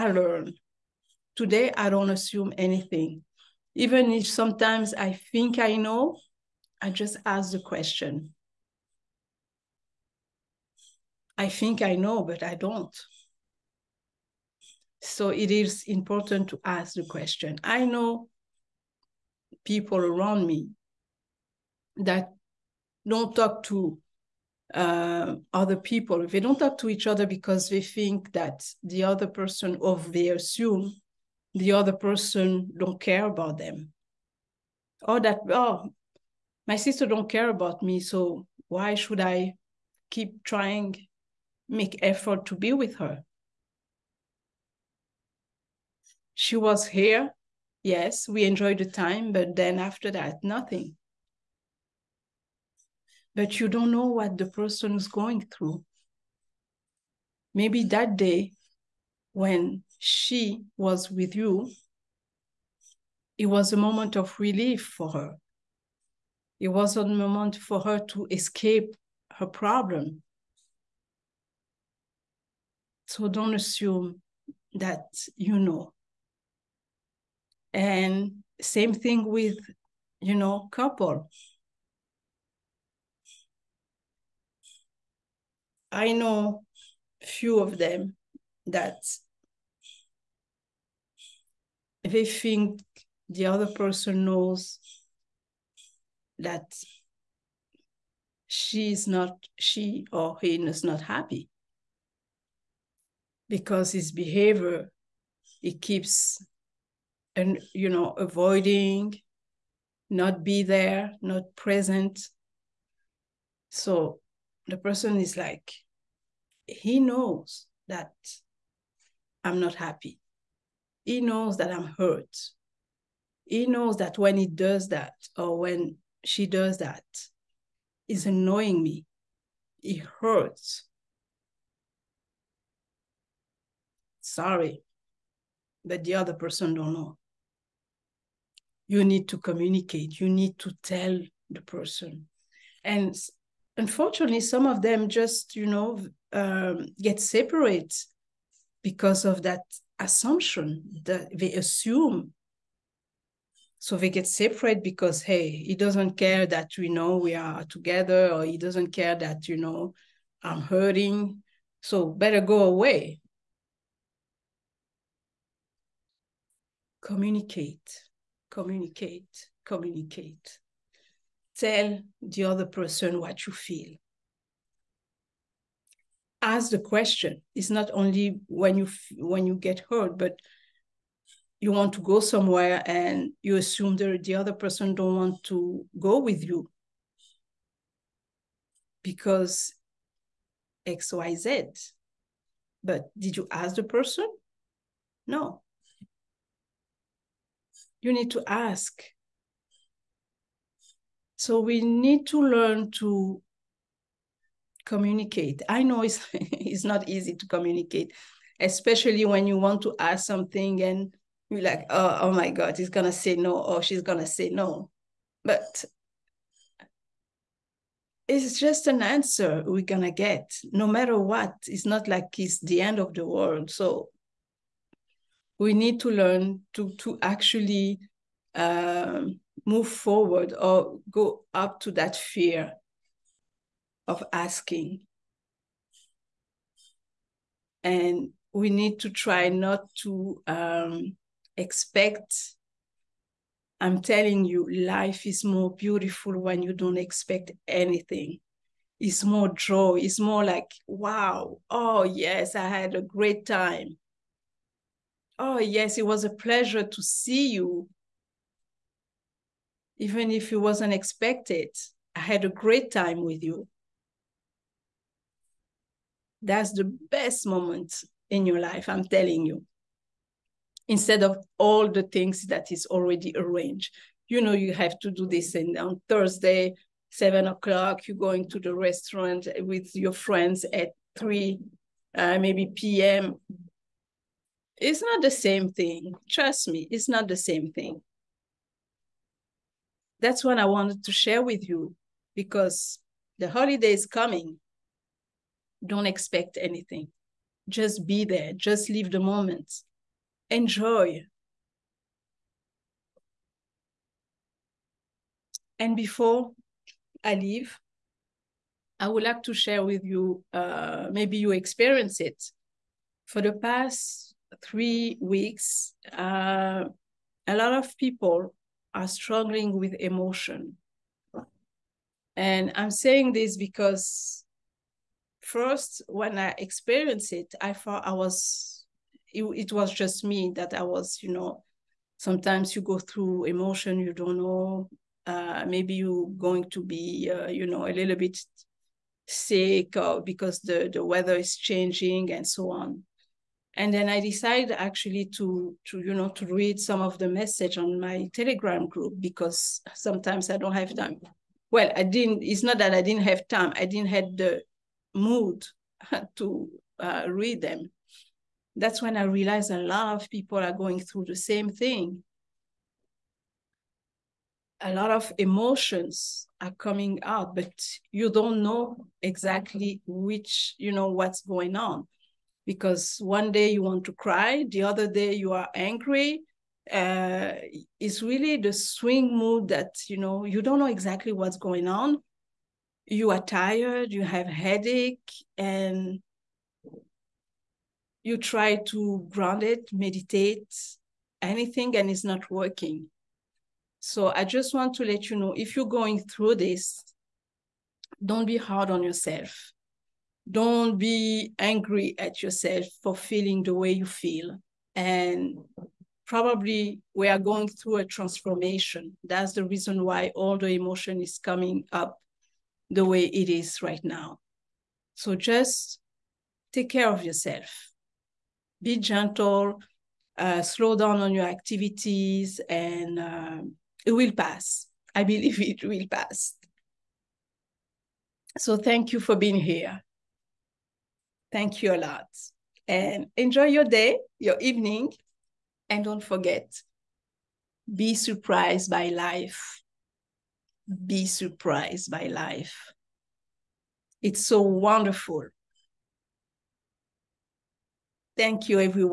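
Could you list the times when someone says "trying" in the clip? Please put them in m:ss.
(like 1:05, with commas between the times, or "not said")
0:40.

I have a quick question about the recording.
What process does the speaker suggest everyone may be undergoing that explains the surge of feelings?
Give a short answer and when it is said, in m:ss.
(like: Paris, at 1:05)
a transformation, at 6:47.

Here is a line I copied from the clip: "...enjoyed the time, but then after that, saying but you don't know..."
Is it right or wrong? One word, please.
wrong.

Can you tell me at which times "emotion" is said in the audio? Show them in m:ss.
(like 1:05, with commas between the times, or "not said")
5:19, 5:33, 6:05, 6:50.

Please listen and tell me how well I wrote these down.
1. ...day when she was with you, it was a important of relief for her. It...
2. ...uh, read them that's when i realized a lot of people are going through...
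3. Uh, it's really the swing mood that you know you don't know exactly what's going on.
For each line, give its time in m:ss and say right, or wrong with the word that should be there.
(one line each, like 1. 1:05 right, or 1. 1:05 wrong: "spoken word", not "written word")
1. 0:58 wrong: "moment", not "important"
2. 5:56 right
3. 6:16 right.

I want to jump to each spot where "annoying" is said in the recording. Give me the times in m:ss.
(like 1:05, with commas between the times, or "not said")
2:08.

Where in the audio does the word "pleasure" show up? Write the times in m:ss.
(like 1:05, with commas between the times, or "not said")
4:16.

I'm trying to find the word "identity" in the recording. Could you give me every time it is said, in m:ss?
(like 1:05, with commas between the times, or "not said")
not said.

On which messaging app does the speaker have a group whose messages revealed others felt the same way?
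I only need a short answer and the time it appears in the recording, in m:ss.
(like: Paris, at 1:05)
Telegram, at 5:48.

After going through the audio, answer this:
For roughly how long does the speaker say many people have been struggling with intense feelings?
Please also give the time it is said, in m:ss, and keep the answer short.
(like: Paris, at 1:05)
three weeks, at 5:13.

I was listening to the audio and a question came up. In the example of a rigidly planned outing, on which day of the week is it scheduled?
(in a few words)
Thursday.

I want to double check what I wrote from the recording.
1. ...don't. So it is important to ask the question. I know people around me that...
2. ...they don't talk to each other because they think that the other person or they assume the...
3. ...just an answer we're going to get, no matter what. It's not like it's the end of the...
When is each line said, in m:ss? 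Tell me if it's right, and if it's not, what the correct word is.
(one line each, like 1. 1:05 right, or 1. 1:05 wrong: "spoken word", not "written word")
1. 0:12 right
2. 0:26 right
3. 3:38 right.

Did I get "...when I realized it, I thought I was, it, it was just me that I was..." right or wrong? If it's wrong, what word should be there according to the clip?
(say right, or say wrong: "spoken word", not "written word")
wrong: "experienced", not "realized".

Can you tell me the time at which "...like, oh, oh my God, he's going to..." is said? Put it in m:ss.
3:31.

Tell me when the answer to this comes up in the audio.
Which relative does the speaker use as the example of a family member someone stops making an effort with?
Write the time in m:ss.
0:36.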